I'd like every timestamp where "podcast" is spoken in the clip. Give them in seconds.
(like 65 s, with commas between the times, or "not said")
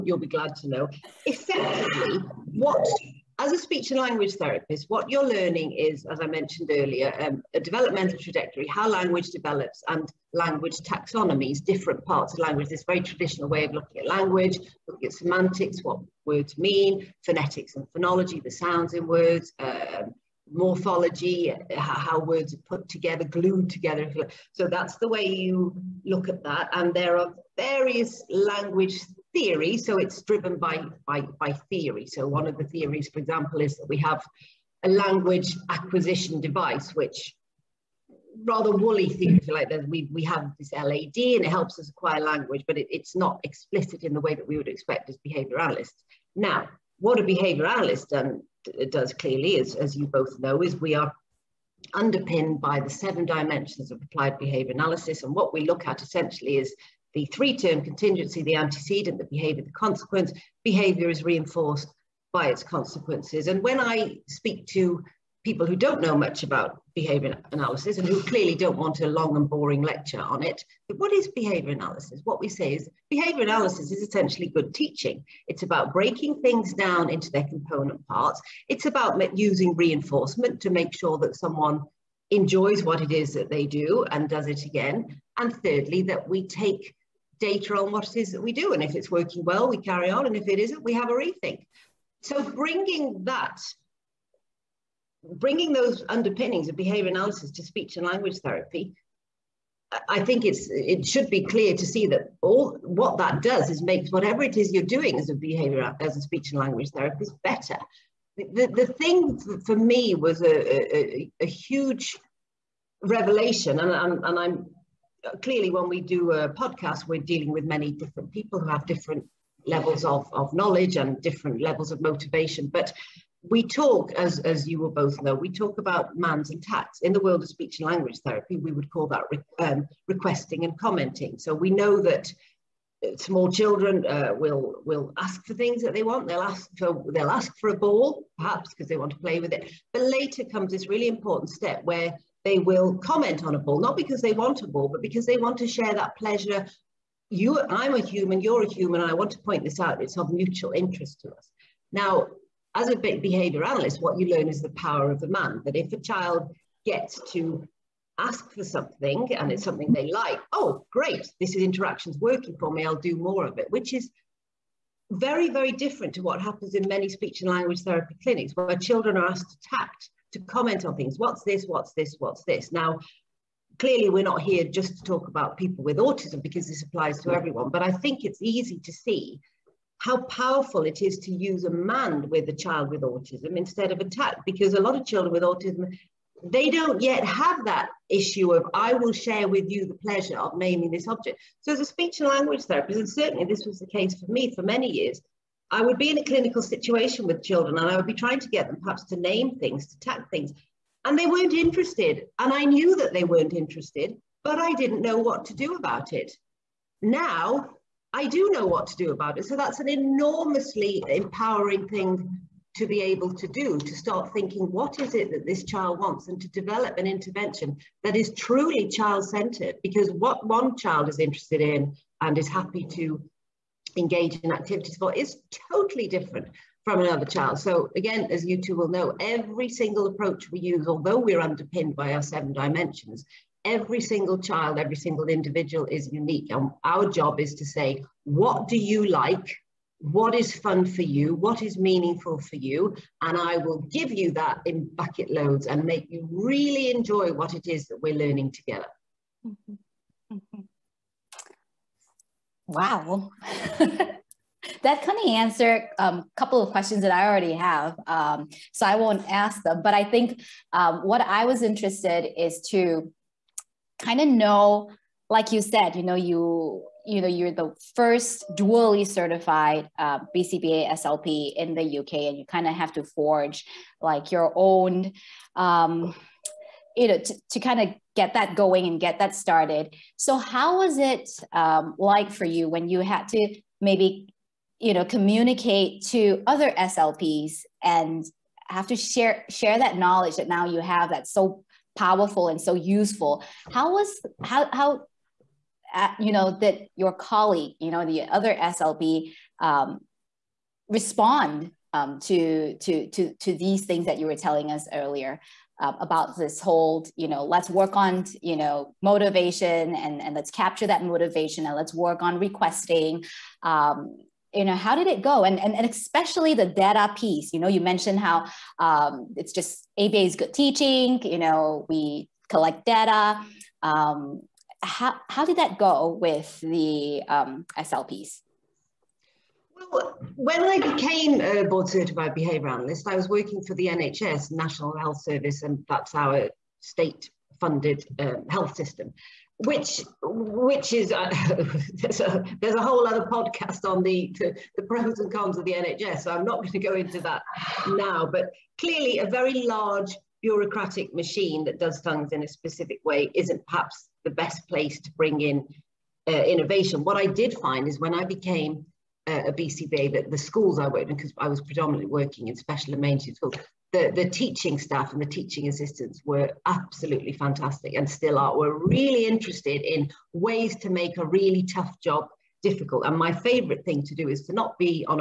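116 s, 343 s.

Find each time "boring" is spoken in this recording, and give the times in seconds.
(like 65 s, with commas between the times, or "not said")
69 s.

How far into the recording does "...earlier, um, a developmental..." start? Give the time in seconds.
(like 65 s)
6 s.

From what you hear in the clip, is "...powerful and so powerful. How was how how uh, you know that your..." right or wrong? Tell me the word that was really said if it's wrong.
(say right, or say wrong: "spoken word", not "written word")
wrong: "useful", not "powerful".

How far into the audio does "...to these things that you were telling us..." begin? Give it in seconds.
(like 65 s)
303 s.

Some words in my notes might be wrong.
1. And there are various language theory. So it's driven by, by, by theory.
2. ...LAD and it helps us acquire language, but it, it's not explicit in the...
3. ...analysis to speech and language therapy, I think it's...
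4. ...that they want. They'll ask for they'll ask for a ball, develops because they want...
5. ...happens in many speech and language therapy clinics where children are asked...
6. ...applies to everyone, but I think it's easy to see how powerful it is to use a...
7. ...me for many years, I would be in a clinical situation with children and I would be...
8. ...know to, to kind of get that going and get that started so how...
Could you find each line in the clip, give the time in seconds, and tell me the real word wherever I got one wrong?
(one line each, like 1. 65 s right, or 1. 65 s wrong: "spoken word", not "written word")
1. 26 s right
2. 40 s right
3. 97 s right
4. 135 s wrong: "perhaps", not "develops"
5. 166 s right
6. 176 s right
7. 194 s right
8. 277 s right.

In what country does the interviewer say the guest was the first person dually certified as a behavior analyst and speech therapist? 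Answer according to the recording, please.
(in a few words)
UK.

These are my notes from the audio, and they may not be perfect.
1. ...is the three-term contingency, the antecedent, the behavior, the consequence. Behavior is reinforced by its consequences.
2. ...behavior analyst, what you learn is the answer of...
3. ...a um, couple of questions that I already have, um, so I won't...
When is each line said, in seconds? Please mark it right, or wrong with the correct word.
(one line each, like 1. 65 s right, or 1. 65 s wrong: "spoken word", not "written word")
1. 56 s right
2. 152 s wrong: "power", not "answer"
3. 255 s right.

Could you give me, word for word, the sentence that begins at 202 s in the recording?
And I knew that they weren't interested, but I didn't know what to do about it.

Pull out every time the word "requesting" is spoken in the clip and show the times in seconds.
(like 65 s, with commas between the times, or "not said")
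130 s, 312 s.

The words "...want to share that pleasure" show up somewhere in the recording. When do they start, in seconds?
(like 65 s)
145 s.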